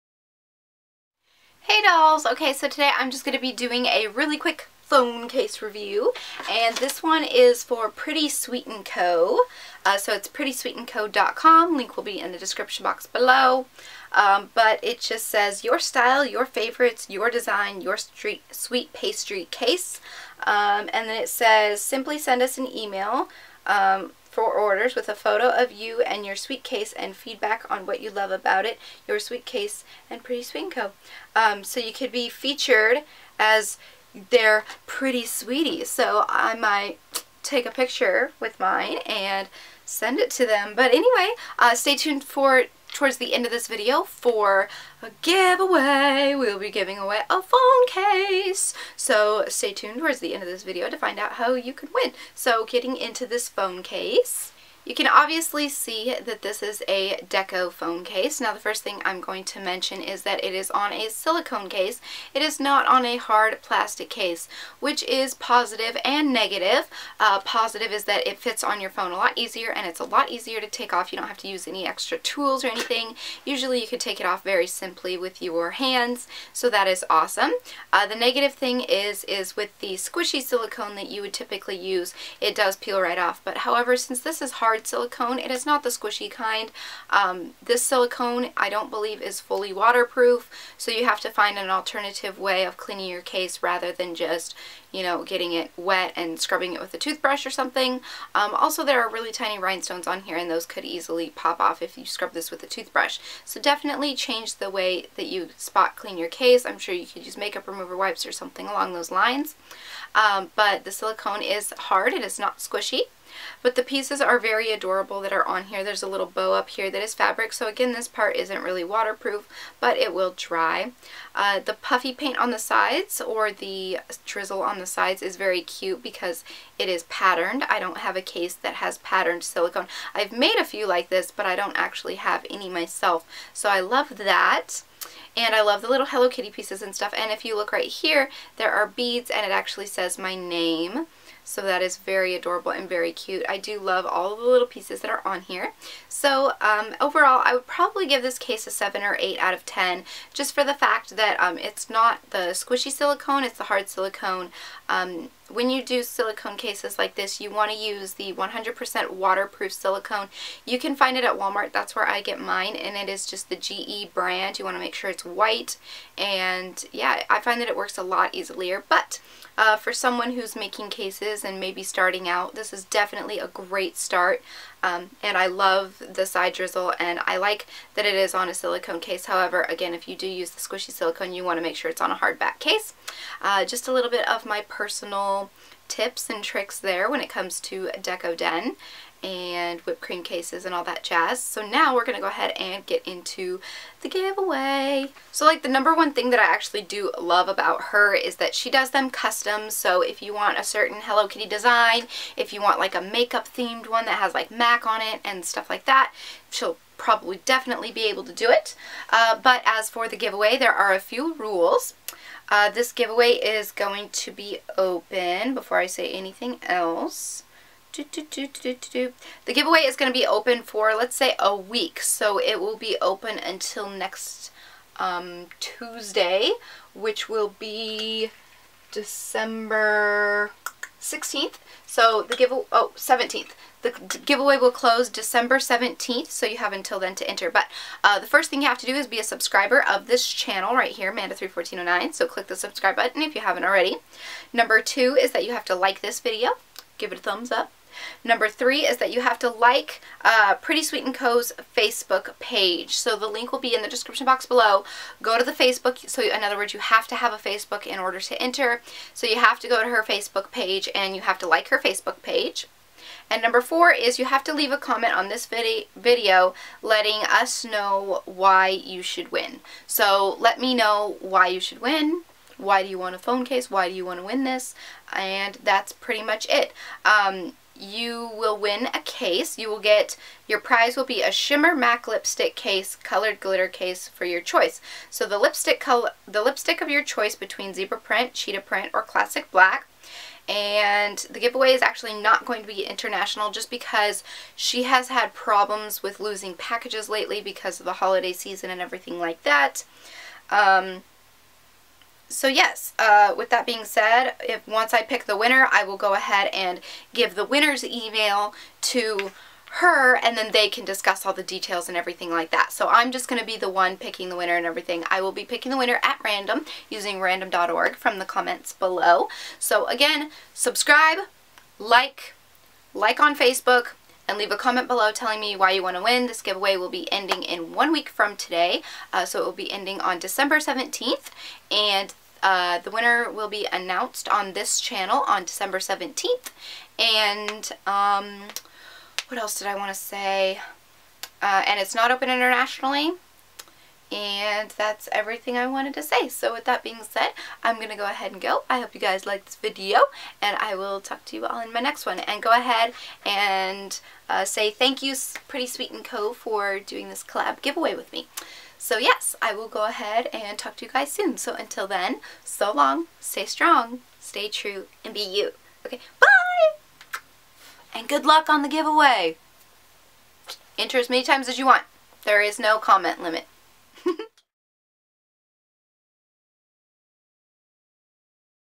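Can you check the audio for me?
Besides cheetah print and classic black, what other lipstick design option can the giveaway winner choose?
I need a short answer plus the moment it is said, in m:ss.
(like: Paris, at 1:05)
Zebra print, at 4:47.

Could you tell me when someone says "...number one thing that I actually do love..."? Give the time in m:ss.
3:15.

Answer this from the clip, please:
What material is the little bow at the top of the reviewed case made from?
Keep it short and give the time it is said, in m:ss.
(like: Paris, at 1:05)
Fabric, at 1:57.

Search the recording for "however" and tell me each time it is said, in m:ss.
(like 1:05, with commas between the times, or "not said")
1:23, 2:59.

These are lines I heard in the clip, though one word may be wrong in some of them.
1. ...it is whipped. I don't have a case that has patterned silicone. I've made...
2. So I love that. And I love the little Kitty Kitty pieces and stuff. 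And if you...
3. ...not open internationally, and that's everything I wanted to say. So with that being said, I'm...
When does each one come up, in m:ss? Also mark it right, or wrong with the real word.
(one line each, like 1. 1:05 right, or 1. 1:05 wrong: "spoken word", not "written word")
1. 2:06 wrong: "patterned", not "whipped"
2. 2:13 wrong: "Hello", not "Kitty"
3. 5:41 right.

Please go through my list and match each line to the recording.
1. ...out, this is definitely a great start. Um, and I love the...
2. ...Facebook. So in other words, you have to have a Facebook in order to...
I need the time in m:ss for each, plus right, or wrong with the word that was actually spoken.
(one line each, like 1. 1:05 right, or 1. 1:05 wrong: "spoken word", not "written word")
1. 2:52 right
2. 4:15 right.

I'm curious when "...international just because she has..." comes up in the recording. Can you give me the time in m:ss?
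4:52.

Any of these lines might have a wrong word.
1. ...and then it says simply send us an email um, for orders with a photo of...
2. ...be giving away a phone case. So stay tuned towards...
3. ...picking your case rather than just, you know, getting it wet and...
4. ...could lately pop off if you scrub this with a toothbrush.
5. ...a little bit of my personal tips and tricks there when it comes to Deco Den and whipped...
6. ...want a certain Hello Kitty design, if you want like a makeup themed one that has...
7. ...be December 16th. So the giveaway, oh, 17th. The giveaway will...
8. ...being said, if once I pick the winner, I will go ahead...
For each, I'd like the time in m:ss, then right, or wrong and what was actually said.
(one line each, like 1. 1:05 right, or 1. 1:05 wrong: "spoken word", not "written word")
1. 0:20 right
2. 0:46 right
3. 1:32 wrong: "cleaning", not "picking"
4. 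1:40 wrong: "easily", not "lately"
5. 3:03 right
6. 3:20 right
7. 3:47 right
8. 5:03 right.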